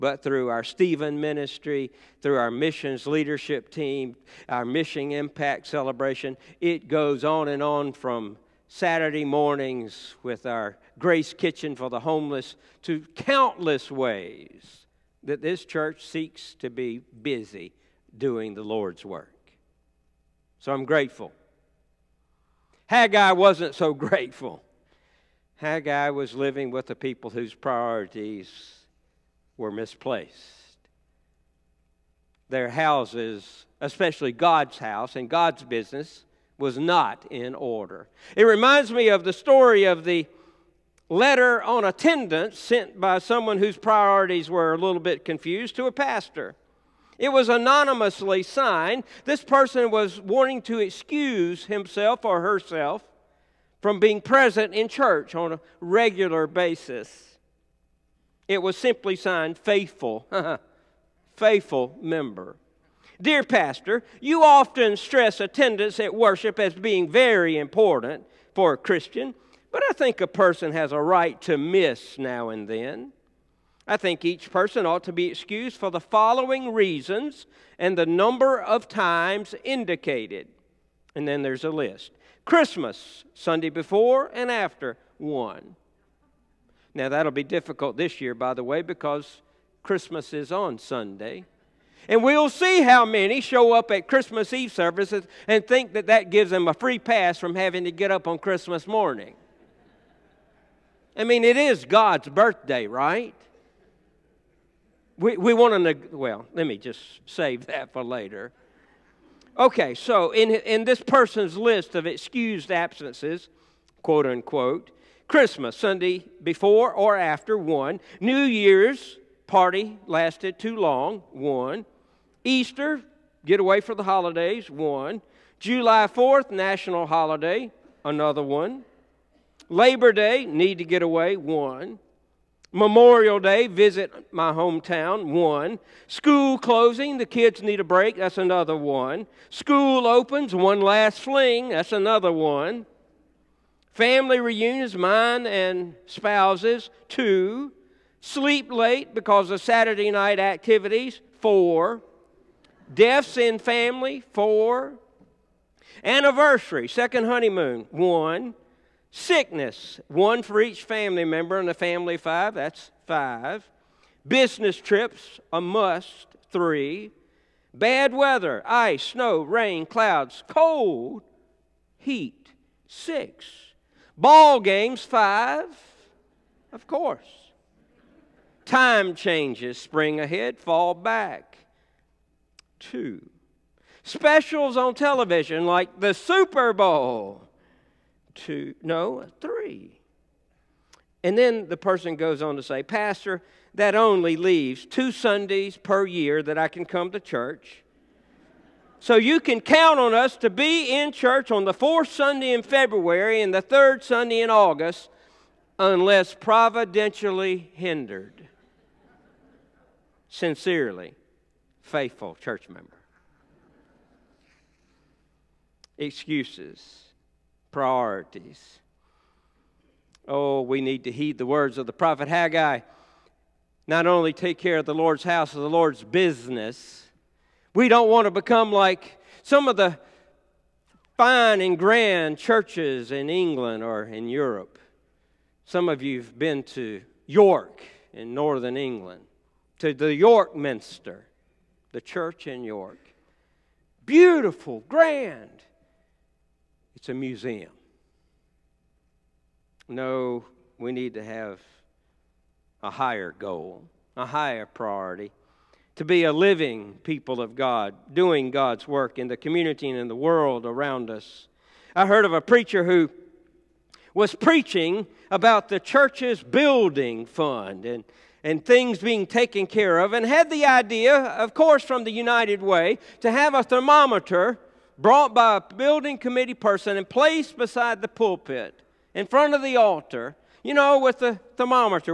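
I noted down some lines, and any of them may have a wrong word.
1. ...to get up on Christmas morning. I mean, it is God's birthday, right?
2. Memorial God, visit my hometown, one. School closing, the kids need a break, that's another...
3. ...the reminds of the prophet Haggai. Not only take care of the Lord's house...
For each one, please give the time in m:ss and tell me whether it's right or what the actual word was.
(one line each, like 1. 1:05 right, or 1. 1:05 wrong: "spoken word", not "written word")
1. 1:37 right
2. 2:12 wrong: "Day", not "God"
3. 3:41 wrong: "words", not "reminds".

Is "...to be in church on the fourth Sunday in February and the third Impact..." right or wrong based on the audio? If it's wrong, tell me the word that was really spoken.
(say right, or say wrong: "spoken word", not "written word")
wrong: "Sunday", not "Impact".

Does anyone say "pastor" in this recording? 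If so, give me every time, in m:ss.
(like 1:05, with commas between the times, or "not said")
0:45, 1:03, 3:12.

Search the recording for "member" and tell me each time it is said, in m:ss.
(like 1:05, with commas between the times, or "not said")
1:02, 2:41, 3:32.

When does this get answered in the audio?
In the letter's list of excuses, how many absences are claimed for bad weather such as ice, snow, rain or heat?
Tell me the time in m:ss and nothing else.
2:52.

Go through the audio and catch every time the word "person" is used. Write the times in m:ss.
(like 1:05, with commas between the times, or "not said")
0:49, 1:10, 1:14, 1:51, 3:11, 4:36.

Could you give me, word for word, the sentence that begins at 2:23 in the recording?
Family reunions, mine and spouses, two.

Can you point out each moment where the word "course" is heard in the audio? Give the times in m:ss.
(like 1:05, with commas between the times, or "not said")
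2:56, 4:31.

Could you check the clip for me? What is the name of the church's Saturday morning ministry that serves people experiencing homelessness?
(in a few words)
Grace Kitchen.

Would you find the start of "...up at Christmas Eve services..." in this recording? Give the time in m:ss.
1:33.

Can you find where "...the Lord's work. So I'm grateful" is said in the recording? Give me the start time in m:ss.
0:18.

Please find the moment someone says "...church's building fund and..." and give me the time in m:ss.
4:25.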